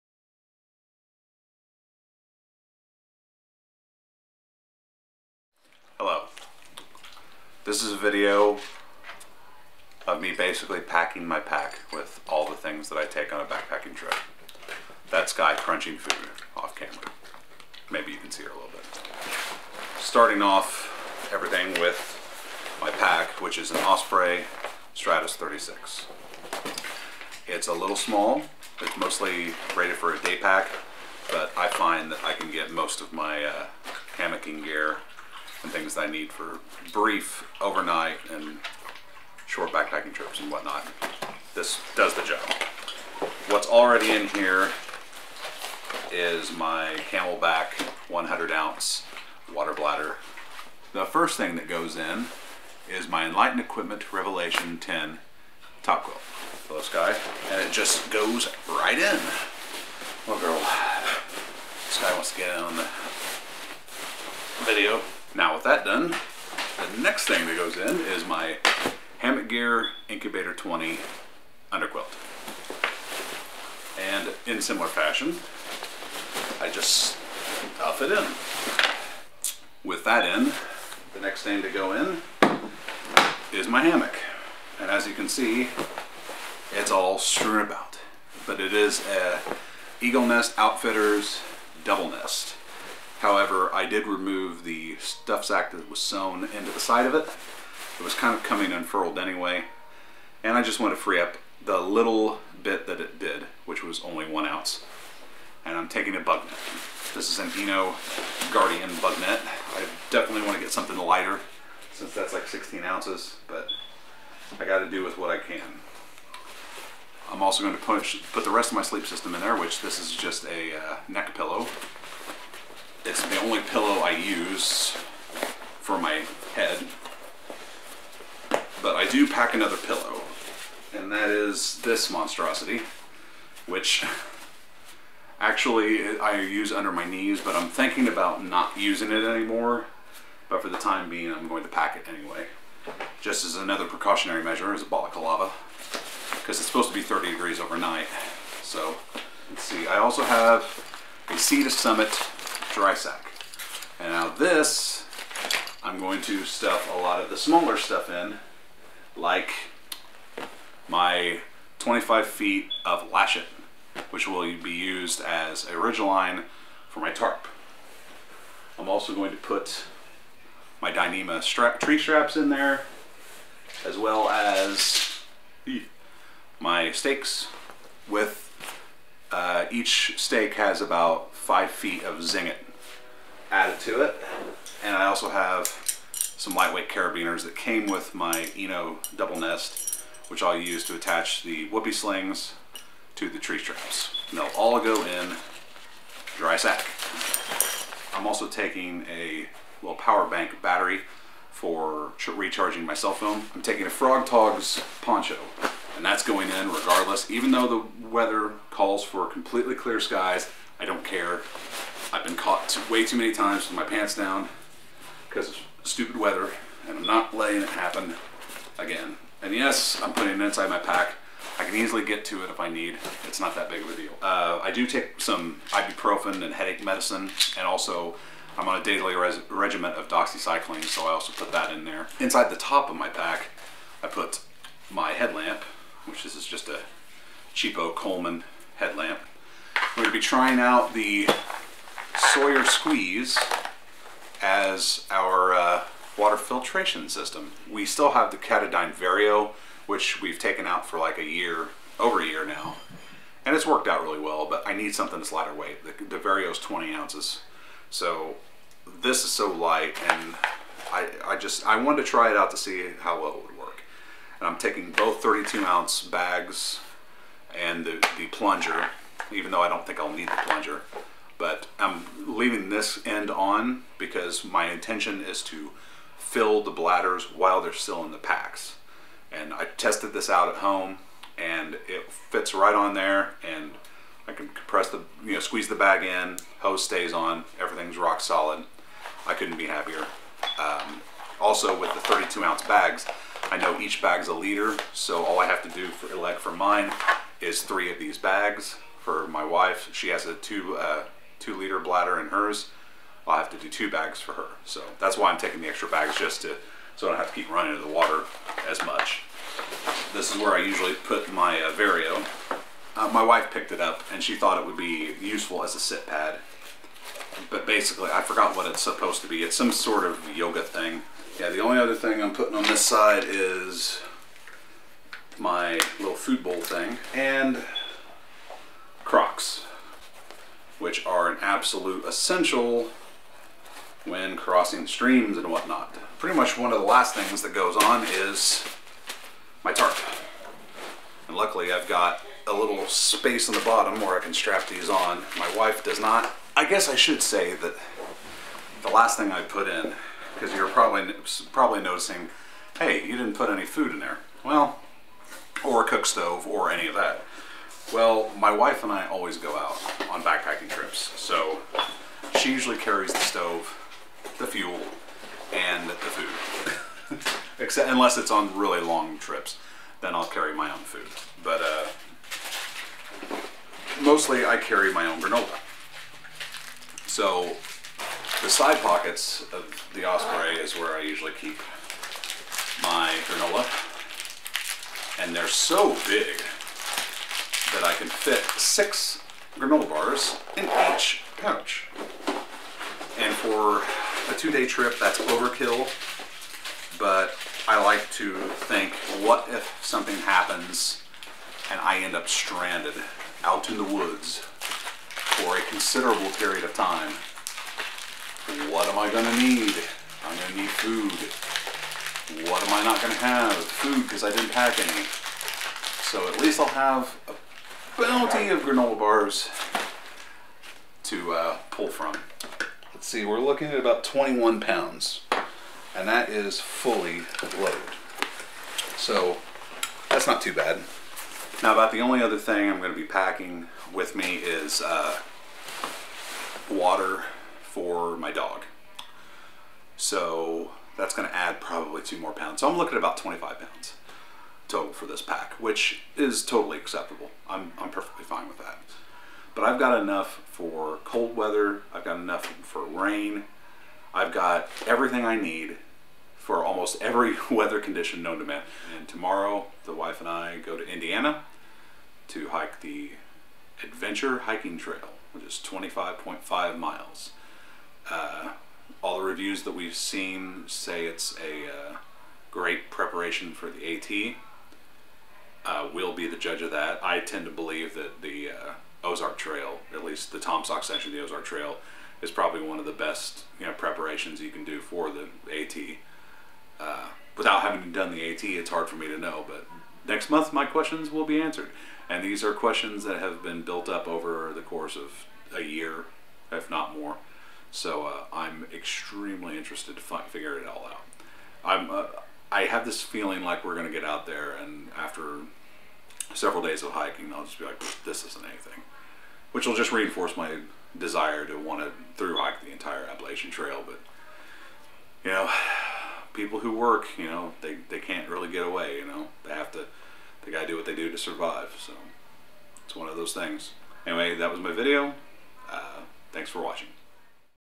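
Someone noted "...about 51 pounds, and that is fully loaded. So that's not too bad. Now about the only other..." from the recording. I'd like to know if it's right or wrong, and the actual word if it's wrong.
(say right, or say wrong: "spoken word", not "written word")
wrong: "21", not "51".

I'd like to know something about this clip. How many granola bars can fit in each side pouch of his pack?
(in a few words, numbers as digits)
6.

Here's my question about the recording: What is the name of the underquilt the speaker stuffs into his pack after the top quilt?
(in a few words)
Hammock Gear Incubator 20.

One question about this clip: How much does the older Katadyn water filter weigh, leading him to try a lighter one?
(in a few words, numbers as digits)
20 ounces.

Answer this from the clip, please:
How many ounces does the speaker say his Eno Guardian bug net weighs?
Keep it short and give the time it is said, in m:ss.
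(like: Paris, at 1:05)
16 ounces, at 1:52.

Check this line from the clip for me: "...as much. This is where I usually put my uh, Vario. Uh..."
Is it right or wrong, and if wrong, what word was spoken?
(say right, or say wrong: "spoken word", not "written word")
right.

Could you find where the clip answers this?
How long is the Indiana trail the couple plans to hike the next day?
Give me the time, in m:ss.
7:45.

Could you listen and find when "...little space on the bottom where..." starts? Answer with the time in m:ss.
5:42.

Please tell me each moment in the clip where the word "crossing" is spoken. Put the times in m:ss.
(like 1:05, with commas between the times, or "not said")
5:34.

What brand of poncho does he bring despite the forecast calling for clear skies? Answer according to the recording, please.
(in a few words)
Frog Togs.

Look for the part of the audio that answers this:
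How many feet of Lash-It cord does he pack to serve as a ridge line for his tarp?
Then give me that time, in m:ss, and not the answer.
2:41.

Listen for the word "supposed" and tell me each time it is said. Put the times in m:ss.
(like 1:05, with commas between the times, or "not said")
2:26, 5:18.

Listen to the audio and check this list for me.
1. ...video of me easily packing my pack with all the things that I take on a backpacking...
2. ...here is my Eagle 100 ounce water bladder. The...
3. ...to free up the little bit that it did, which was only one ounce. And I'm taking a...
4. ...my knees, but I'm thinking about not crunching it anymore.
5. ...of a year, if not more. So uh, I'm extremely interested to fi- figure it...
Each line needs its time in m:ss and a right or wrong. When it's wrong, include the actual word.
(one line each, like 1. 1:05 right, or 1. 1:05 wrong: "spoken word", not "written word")
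1. 0:07 wrong: "basically", not "easily"
2. 0:44 wrong: "Camelbak", not "Eagle"
3. 1:40 right
4. 2:16 wrong: "using", not "crunching"
5. 8:14 right.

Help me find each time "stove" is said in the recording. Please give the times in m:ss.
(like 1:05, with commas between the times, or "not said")
5:56, 6:03.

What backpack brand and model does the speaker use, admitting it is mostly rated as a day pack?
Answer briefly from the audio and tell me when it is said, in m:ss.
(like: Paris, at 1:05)
Osprey Stratos 36, at 0:23.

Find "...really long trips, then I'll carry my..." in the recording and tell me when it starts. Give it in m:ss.
6:08.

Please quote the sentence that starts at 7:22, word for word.
So I'm looking at about 25 pounds total for this pack, which is totally acceptable.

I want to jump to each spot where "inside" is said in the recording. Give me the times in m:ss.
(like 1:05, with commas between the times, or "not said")
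3:40, 3:52.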